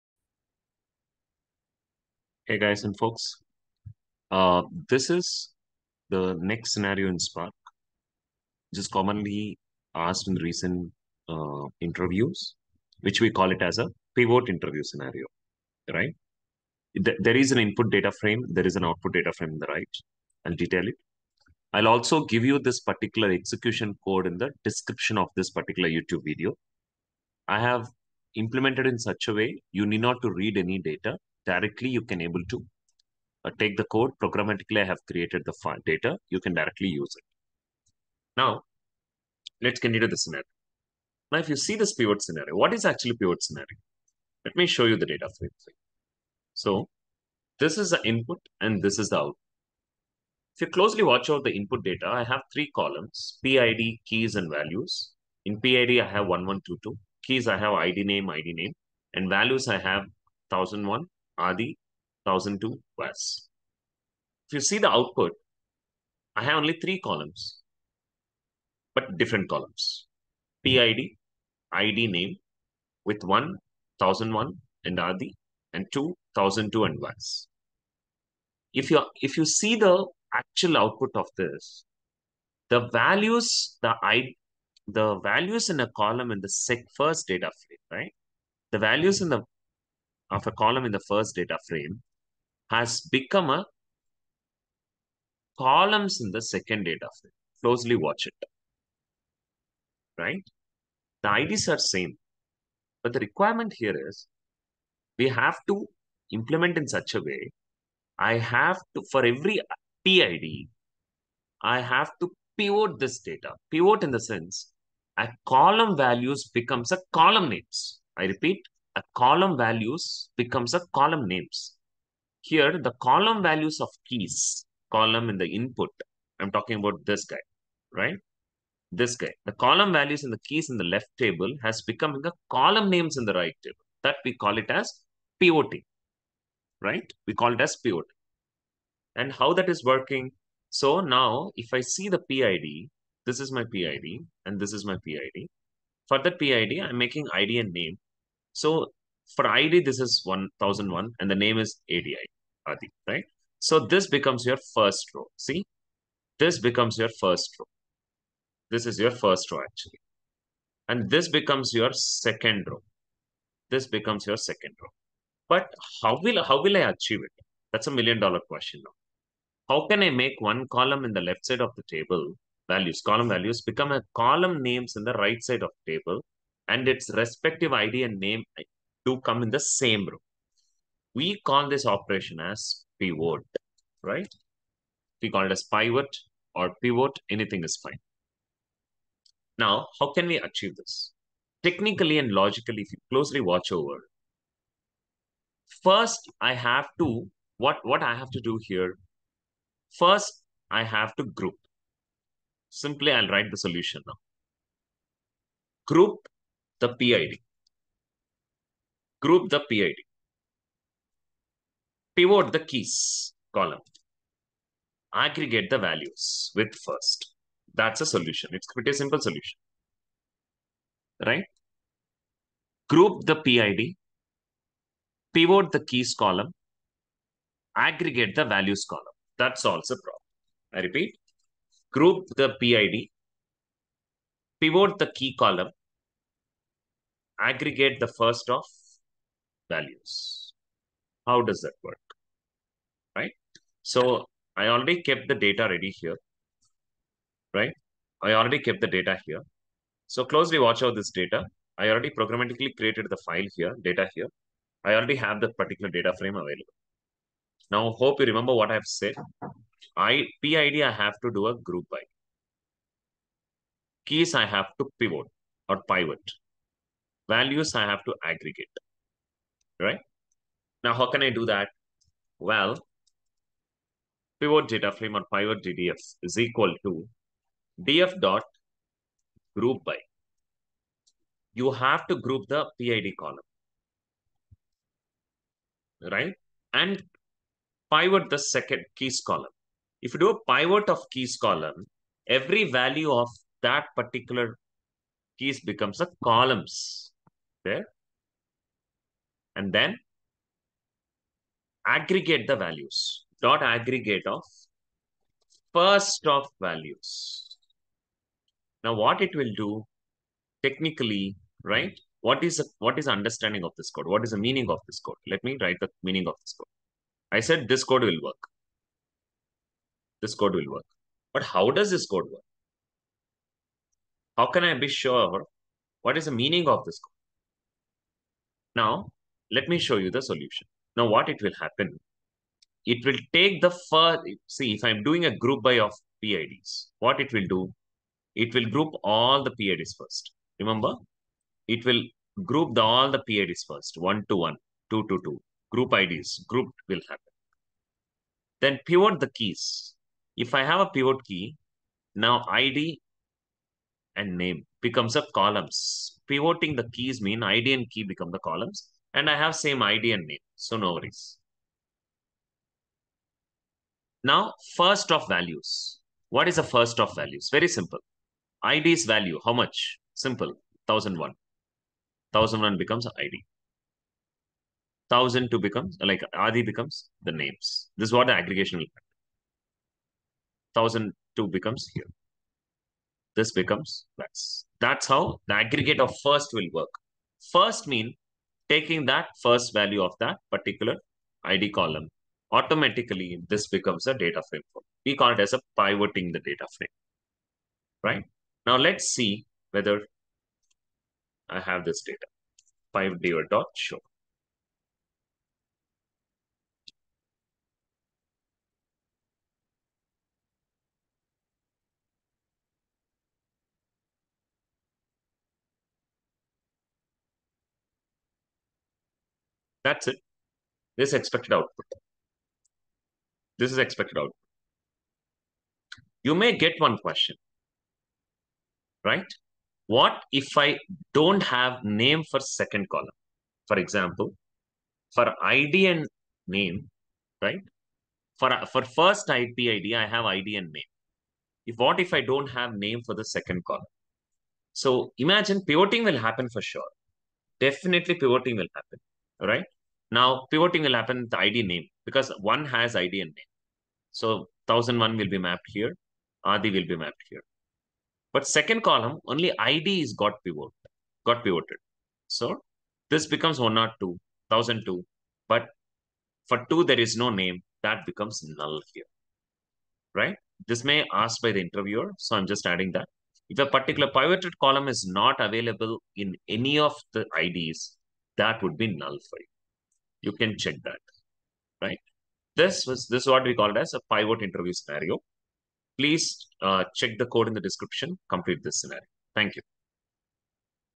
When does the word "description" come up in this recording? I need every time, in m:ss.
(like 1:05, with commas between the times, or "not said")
0:24, 8:07.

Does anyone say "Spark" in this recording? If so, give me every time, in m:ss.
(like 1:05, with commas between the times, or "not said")
0:07.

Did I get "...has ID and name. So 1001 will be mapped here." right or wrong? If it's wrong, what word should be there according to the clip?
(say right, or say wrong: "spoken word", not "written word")
right.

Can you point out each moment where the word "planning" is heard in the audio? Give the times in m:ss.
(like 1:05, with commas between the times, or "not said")
not said.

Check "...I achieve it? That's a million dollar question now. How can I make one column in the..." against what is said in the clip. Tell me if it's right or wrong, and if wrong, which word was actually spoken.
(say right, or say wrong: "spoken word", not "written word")
right.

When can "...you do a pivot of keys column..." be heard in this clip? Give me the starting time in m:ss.
4:50.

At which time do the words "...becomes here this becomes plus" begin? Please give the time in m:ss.
6:21.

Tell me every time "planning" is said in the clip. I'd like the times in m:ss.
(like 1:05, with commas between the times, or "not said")
not said.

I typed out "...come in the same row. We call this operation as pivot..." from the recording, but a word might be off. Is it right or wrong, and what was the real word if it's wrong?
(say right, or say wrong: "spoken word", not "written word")
right.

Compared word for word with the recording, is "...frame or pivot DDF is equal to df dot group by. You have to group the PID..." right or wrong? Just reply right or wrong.
right.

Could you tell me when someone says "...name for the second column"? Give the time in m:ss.
7:22.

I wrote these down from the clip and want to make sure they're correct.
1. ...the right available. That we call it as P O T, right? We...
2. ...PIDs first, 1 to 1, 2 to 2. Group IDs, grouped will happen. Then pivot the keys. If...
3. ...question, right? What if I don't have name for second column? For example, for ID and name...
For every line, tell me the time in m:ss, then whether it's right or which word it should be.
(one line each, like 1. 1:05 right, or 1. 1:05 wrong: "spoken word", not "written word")
1. 2:13 wrong: "table", not "available"
2. 5:43 right
3. 7:06 right.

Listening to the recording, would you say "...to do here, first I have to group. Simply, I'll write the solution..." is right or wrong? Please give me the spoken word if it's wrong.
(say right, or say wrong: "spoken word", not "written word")
right.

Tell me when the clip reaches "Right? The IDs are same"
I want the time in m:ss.
1:40.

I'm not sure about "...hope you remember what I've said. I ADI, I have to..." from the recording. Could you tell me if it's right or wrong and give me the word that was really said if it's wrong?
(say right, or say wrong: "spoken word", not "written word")
wrong: "PID", not "ADI".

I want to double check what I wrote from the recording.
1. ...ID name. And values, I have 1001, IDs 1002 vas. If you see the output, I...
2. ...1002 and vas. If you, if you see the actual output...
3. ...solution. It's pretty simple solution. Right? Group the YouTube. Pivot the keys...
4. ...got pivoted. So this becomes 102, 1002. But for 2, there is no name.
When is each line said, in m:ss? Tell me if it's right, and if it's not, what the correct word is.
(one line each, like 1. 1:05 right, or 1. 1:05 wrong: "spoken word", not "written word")
1. 0:58 wrong: "Adi", not "IDs"
2. 1:16 right
3. 3:38 wrong: "PID", not "YouTube"
4. 7:41 right.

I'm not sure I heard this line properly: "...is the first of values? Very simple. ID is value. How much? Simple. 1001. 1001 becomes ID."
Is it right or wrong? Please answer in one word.
right.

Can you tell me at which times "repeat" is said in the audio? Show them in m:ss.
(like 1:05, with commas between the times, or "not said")
1:58, 3:50.